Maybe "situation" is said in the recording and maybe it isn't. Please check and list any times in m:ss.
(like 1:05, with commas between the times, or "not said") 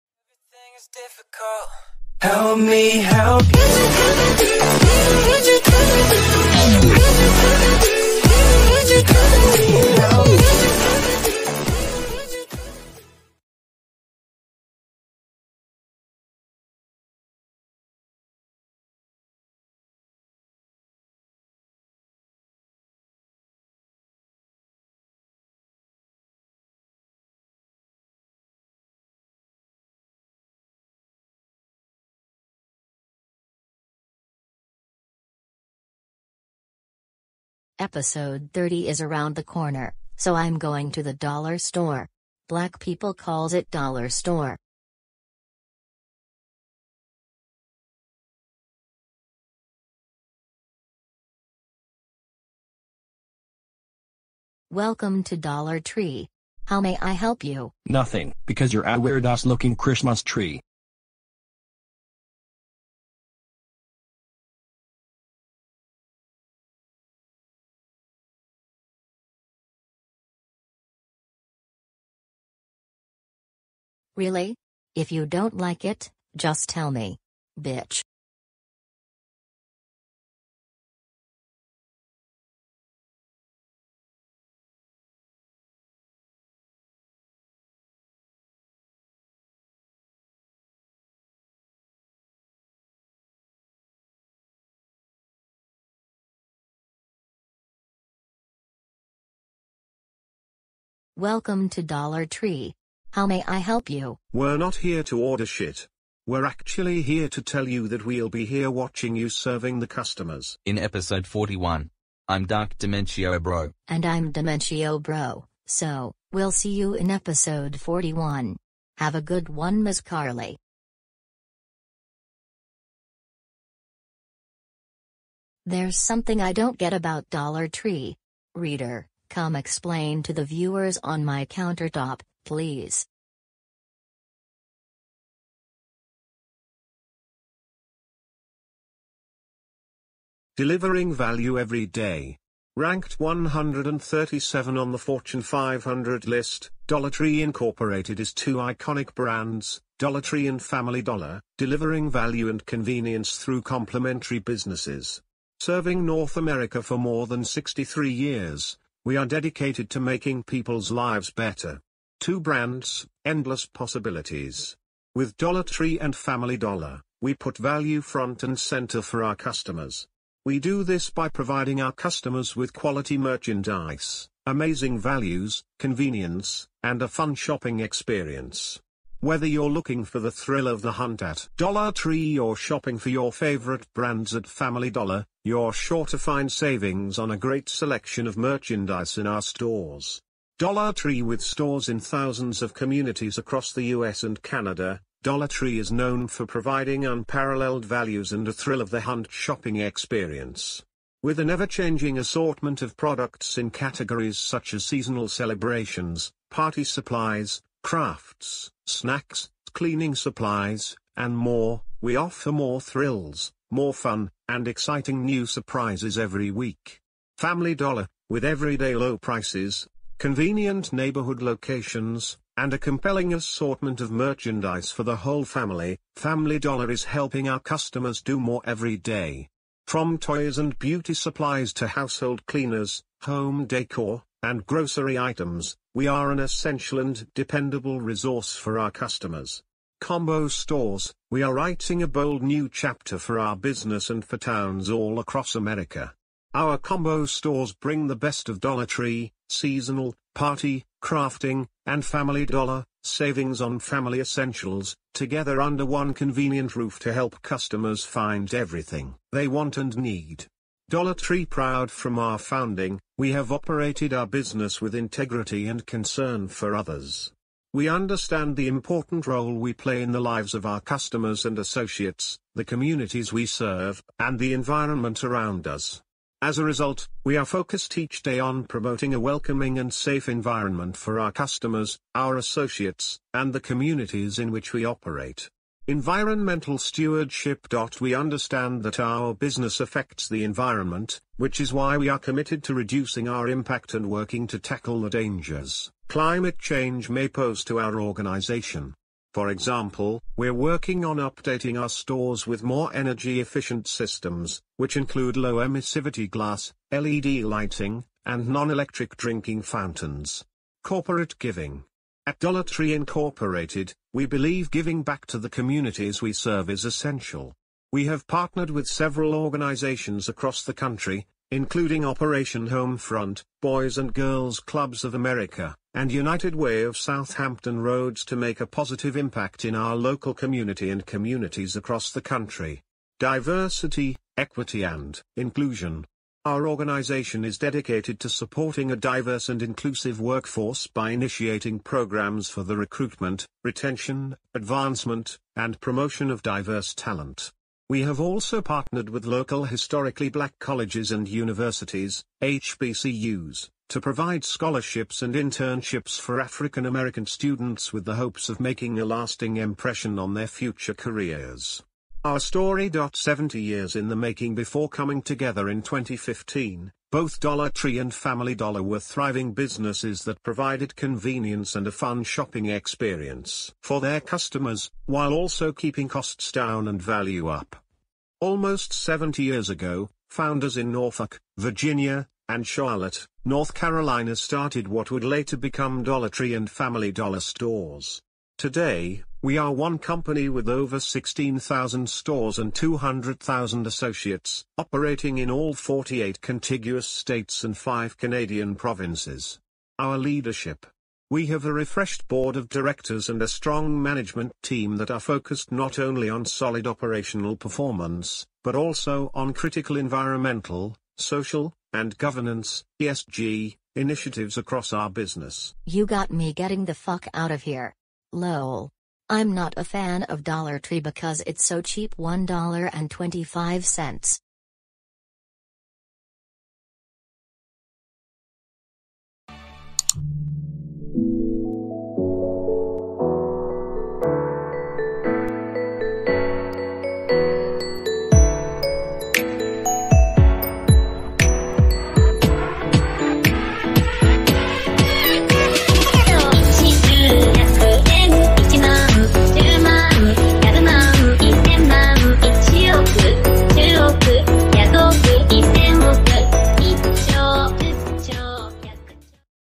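not said.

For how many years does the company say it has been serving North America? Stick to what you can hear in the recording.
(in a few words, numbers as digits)
63.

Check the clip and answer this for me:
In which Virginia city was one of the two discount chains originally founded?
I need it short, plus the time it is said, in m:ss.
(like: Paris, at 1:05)
Norfolk, at 6:20.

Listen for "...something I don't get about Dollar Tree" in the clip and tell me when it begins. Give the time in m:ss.
2:05.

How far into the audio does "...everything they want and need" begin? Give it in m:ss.
4:18.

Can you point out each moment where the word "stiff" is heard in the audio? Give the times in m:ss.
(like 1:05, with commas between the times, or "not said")
not said.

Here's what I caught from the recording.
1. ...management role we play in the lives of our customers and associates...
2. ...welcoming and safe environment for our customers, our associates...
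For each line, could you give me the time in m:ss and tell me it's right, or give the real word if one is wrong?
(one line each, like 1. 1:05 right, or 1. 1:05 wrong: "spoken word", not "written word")
1. 4:28 wrong: "important", not "management"
2. 4:39 right.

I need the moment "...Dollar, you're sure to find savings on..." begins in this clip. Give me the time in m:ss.
3:04.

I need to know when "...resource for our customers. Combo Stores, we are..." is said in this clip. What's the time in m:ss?
3:57.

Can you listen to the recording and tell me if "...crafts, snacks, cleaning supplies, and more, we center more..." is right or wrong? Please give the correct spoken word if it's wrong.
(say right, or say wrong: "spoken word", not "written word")
wrong: "offer", not "center".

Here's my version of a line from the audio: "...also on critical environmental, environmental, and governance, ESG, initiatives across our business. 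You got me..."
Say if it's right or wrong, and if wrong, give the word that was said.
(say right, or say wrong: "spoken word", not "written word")
wrong: "social", not "environmental".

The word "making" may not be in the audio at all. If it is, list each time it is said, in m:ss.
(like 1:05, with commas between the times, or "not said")
2:39, 5:58, 6:04.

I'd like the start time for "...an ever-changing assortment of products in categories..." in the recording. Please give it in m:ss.
3:21.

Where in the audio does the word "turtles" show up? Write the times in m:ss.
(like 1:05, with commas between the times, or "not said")
not said.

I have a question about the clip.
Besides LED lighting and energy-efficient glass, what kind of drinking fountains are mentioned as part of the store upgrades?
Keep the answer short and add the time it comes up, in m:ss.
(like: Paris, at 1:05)
Non-electric, at 5:08.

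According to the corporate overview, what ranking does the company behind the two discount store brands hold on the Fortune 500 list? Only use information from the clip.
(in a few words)
137.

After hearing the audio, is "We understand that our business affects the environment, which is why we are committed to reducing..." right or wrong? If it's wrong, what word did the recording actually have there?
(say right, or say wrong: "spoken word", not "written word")
right.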